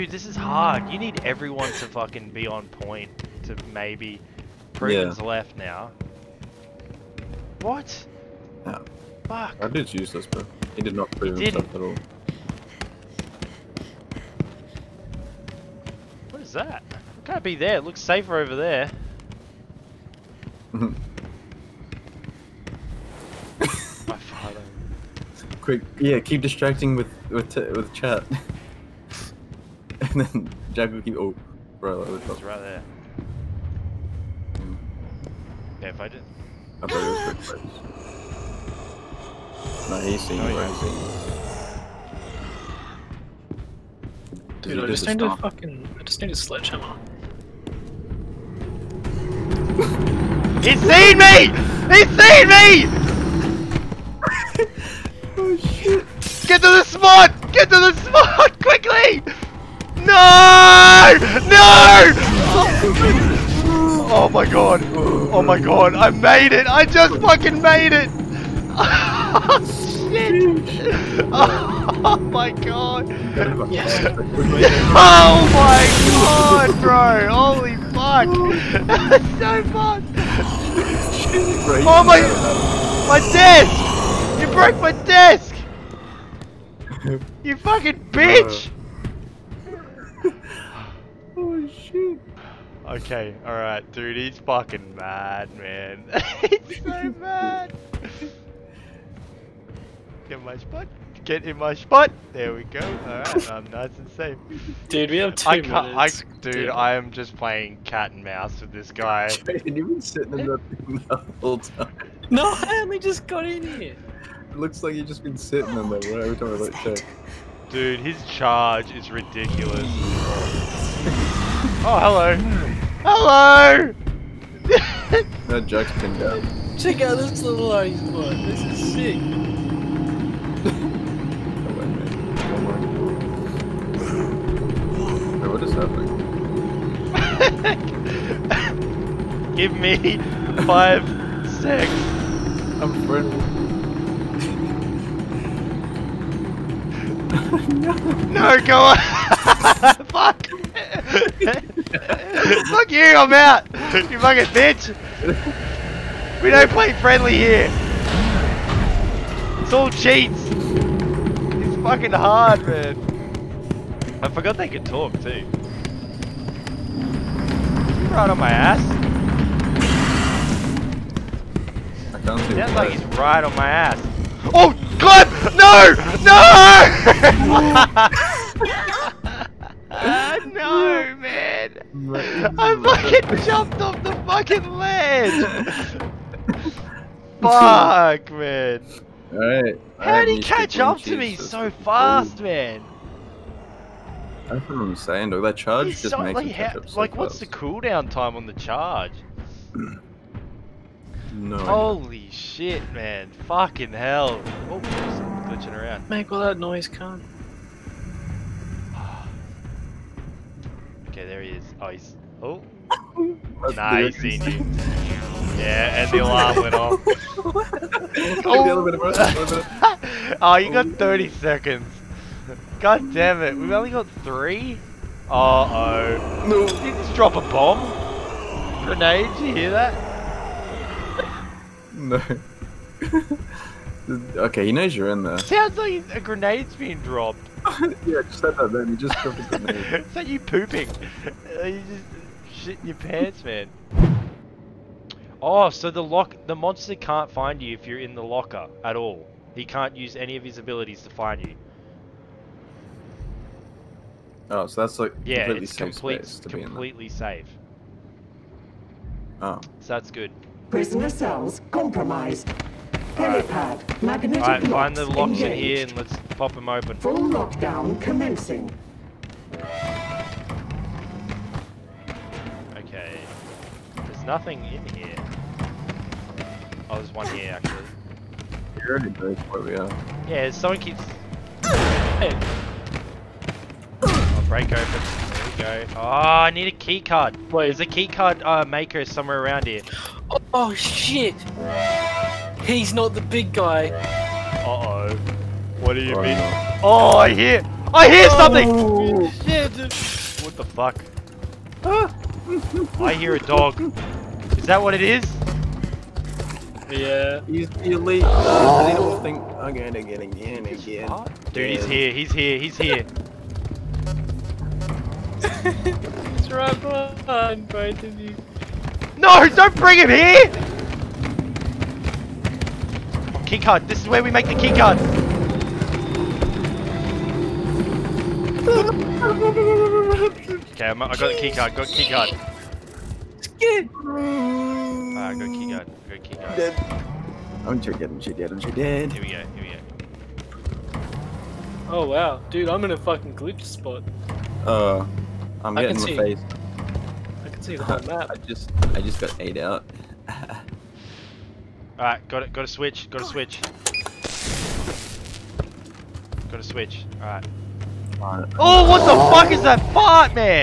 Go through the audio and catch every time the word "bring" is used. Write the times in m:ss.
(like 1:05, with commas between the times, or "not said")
5:19.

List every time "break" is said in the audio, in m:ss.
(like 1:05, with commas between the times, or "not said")
4:44.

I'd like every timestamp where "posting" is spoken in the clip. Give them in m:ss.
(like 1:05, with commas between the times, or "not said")
not said.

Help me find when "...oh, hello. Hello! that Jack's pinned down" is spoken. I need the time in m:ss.
2:01.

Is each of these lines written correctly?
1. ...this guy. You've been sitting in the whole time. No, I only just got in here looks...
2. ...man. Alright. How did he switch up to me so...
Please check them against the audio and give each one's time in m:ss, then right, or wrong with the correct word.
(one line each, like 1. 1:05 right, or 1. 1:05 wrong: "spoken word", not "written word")
1. 1:48 right
2. 3:08 wrong: "catch", not "switch".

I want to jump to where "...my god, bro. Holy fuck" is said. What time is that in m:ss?
1:15.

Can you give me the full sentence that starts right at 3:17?
what's the cooldown time on the charge?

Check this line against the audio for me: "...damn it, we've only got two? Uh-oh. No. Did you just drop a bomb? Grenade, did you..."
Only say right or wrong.
wrong.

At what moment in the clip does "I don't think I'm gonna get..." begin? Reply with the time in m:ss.
5:08.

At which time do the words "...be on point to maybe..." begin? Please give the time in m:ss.
0:02.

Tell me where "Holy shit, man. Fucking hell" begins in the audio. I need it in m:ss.
3:21.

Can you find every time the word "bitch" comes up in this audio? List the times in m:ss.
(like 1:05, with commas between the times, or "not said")
1:28, 2:34.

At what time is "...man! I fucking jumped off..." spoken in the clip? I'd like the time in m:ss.
3:01.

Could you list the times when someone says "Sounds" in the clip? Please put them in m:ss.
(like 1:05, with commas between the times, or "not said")
2:52, 3:55.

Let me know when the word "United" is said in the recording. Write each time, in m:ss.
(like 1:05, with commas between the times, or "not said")
not said.